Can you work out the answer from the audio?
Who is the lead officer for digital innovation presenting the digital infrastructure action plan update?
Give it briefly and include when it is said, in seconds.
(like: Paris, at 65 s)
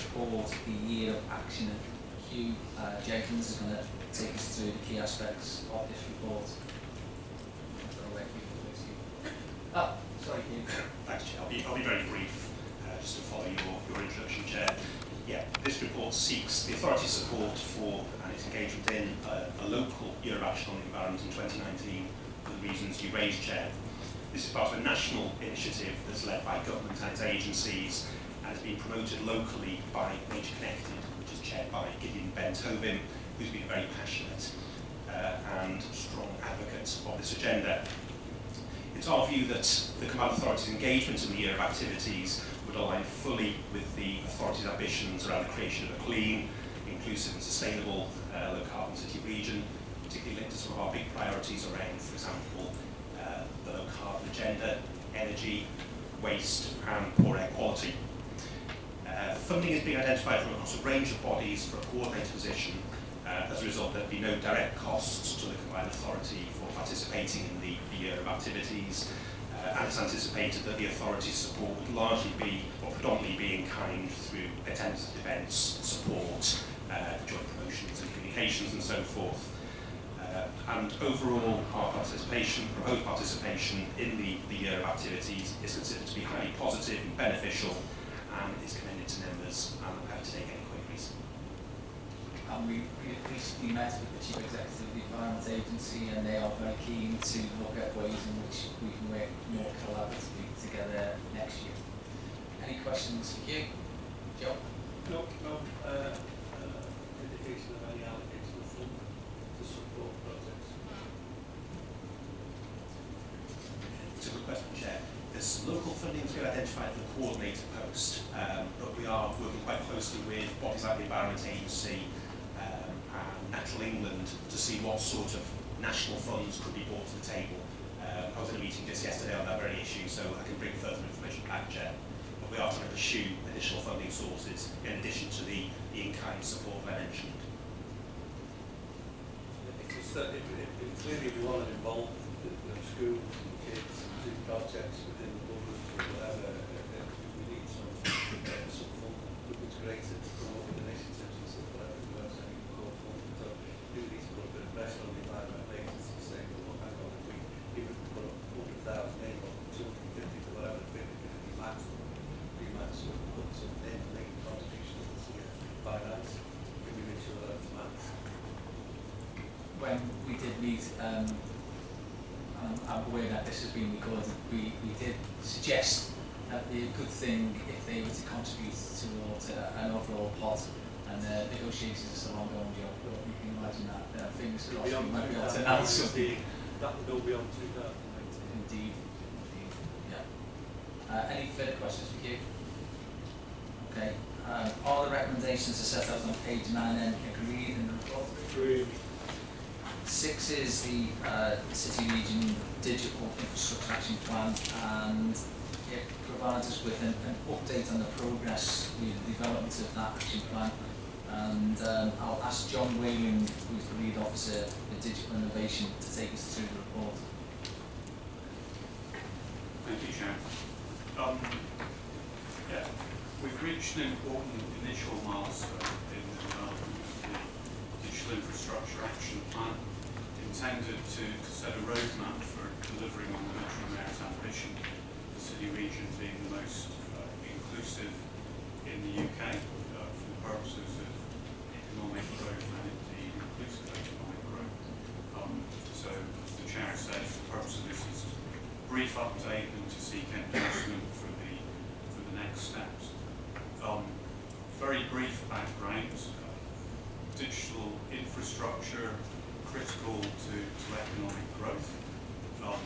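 John Whalen, at 212 s.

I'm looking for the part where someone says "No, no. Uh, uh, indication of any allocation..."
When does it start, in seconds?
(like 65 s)
105 s.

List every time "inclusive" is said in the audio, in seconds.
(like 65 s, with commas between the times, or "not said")
46 s, 237 s, 243 s.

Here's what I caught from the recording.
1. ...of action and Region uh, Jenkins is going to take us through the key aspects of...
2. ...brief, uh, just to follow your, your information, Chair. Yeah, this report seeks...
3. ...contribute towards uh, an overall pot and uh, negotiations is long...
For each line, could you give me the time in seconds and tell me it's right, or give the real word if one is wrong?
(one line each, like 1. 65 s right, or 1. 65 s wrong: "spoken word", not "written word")
1. 1 s wrong: "Hugh", not "Region"
2. 12 s wrong: "introduction", not "information"
3. 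178 s right.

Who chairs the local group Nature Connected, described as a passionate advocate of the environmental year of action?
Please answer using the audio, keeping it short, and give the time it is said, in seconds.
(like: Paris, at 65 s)
Gideon Ben-Tovim, at 31 s.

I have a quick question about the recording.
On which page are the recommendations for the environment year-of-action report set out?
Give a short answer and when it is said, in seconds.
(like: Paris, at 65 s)
9, at 196 s.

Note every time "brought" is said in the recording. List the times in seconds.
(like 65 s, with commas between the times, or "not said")
126 s.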